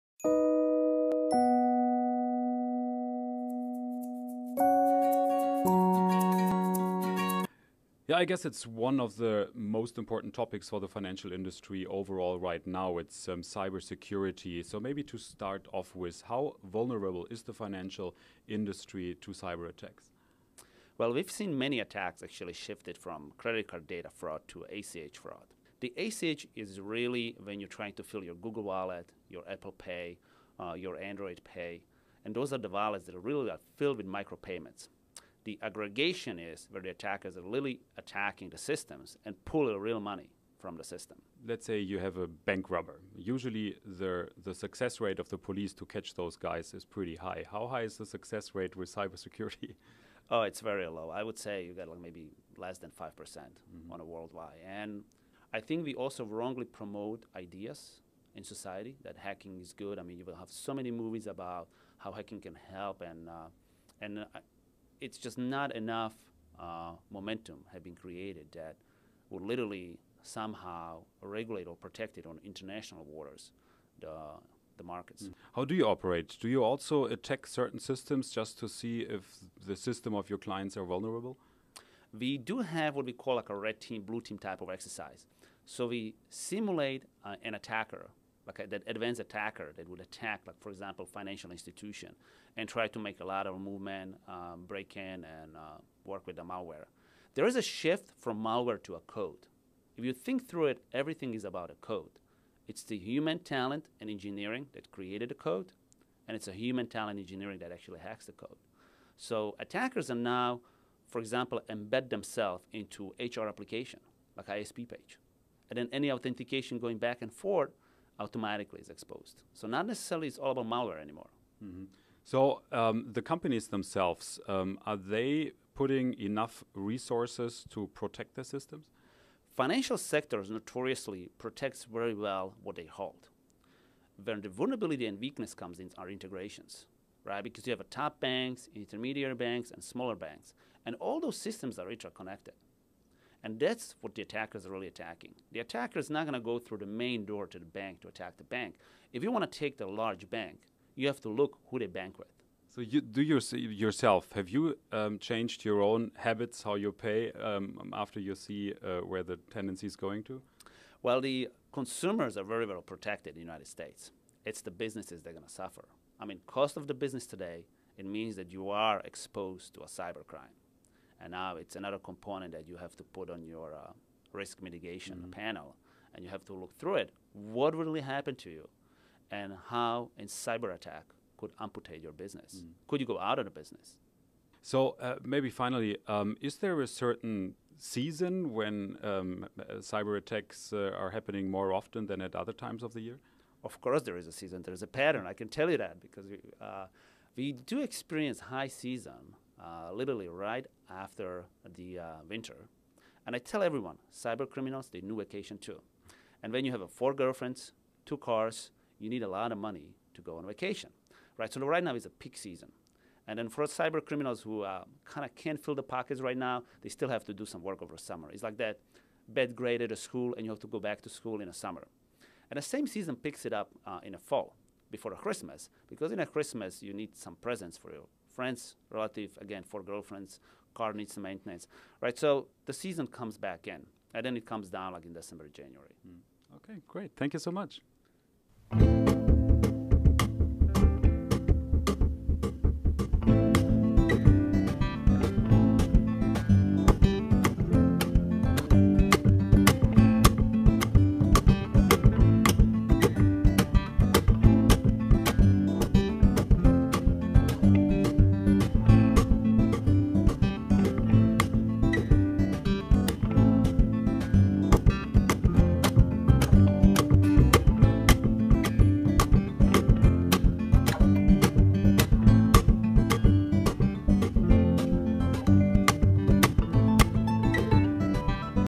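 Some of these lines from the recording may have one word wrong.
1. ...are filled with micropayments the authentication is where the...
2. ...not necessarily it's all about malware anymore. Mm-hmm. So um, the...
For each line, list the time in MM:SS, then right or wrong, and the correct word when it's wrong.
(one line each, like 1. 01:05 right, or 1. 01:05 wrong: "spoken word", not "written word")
1. 00:33 wrong: "aggregation", not "authentication"
2. 01:59 right.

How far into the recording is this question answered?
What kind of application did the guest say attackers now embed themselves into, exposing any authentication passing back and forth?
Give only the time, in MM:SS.
01:53.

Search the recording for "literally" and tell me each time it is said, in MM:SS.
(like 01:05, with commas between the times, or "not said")
01:09, 03:19.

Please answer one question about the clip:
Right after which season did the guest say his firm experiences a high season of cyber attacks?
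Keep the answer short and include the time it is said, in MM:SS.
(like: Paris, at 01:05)
Winter, at 03:22.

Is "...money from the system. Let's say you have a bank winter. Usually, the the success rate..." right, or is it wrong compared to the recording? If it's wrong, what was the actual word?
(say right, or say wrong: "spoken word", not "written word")
wrong: "robber", not "winter".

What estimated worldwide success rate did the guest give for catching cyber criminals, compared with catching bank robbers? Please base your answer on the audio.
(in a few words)
less than 5%.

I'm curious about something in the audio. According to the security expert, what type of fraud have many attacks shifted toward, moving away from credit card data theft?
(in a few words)
ACH fraud.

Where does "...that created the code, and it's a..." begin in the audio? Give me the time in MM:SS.
01:44.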